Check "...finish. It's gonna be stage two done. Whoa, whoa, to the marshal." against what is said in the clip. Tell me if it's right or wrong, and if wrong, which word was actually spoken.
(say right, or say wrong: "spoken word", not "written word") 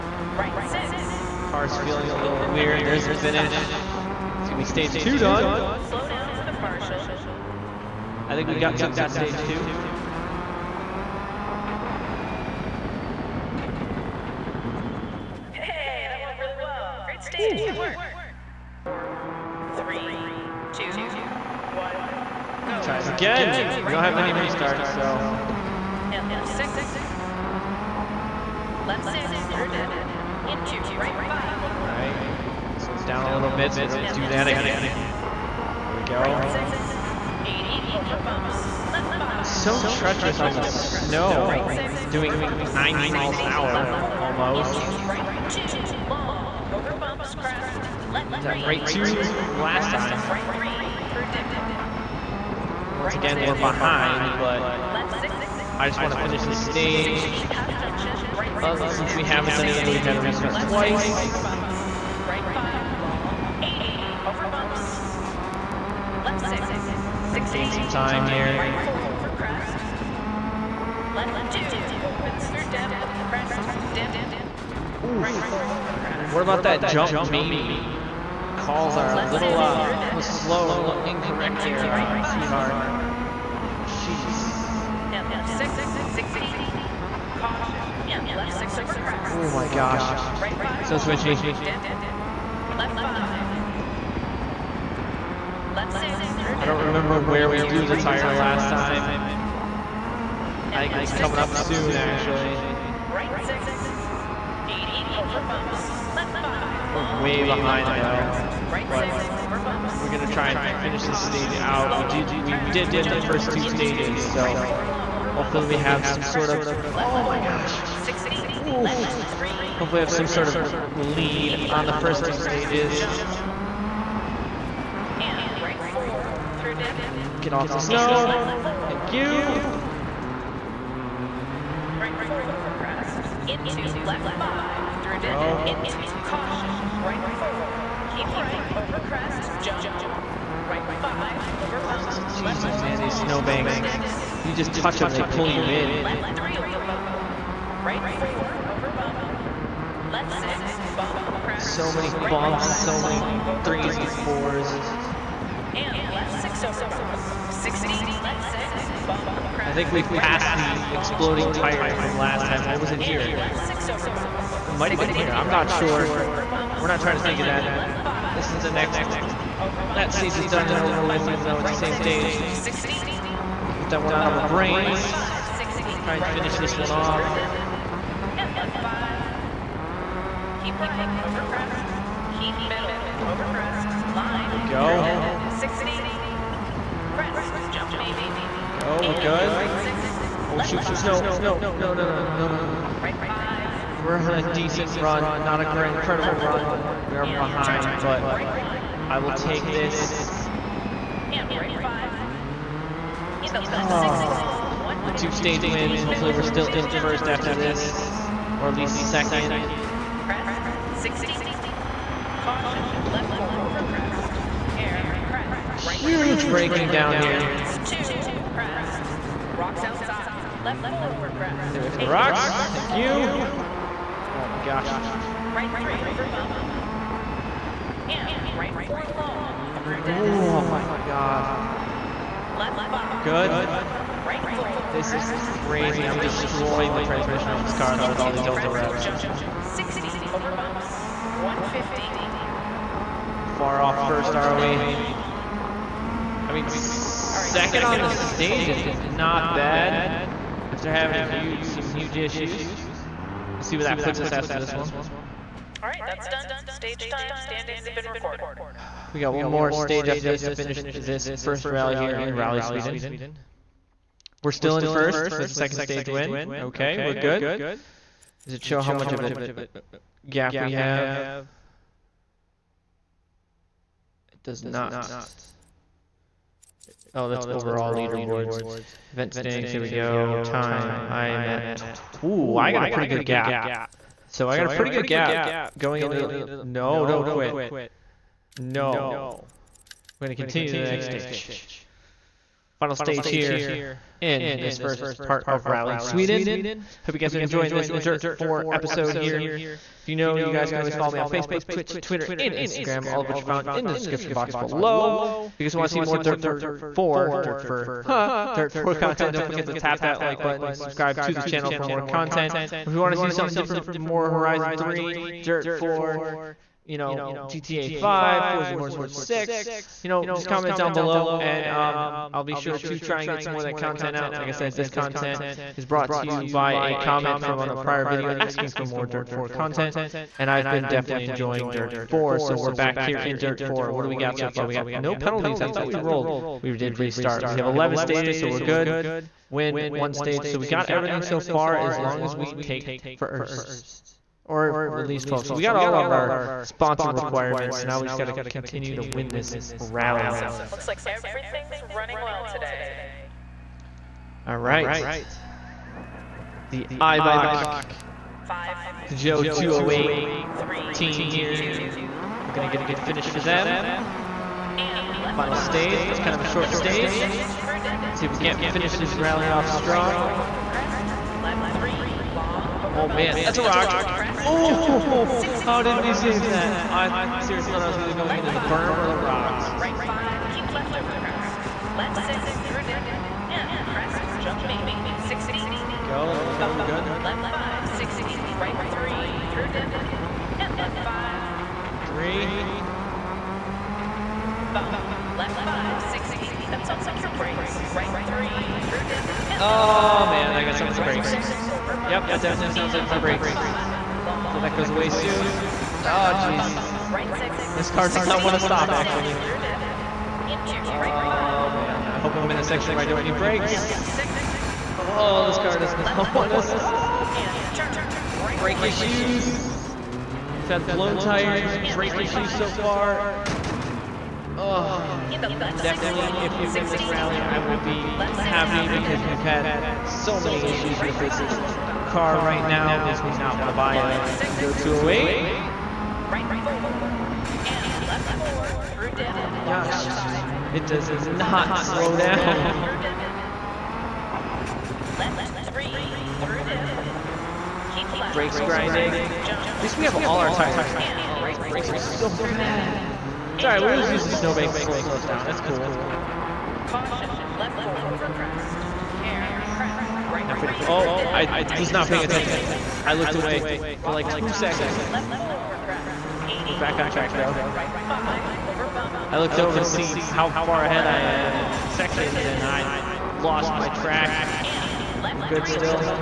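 right.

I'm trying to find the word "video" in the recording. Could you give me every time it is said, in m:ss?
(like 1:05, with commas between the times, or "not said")
5:28.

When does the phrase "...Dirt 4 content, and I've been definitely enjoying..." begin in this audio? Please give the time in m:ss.
5:29.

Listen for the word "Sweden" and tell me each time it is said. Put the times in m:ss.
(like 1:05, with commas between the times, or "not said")
4:22, 4:55.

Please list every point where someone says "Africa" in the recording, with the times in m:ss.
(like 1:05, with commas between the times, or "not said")
not said.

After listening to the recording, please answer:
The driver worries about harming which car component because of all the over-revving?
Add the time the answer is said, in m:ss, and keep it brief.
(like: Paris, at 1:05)
Transmission, at 3:57.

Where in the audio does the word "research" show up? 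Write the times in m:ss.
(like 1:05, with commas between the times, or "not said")
not said.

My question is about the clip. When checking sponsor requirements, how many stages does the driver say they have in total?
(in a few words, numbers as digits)
11.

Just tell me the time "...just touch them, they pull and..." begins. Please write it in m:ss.
2:24.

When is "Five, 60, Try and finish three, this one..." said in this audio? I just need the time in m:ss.
2:55.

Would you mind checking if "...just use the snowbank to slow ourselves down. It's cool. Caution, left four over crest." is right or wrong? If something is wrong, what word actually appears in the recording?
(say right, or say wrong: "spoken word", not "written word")
right.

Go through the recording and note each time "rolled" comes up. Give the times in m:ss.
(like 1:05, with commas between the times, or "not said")
5:35.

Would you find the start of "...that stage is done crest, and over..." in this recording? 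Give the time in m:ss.
2:49.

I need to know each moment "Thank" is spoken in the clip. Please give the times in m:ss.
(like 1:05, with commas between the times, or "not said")
2:08, 3:42.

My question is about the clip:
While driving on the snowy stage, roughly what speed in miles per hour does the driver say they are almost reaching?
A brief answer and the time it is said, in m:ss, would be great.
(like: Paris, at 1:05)
90, at 0:42.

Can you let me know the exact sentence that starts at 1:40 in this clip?
I think it was coming up soon, actually.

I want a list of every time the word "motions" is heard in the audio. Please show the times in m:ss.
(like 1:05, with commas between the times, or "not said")
not said.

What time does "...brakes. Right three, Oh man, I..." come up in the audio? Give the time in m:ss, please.
6:37.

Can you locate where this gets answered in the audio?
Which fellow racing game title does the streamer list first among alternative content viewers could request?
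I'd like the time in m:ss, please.
5:14.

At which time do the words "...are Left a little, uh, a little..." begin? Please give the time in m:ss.
1:18.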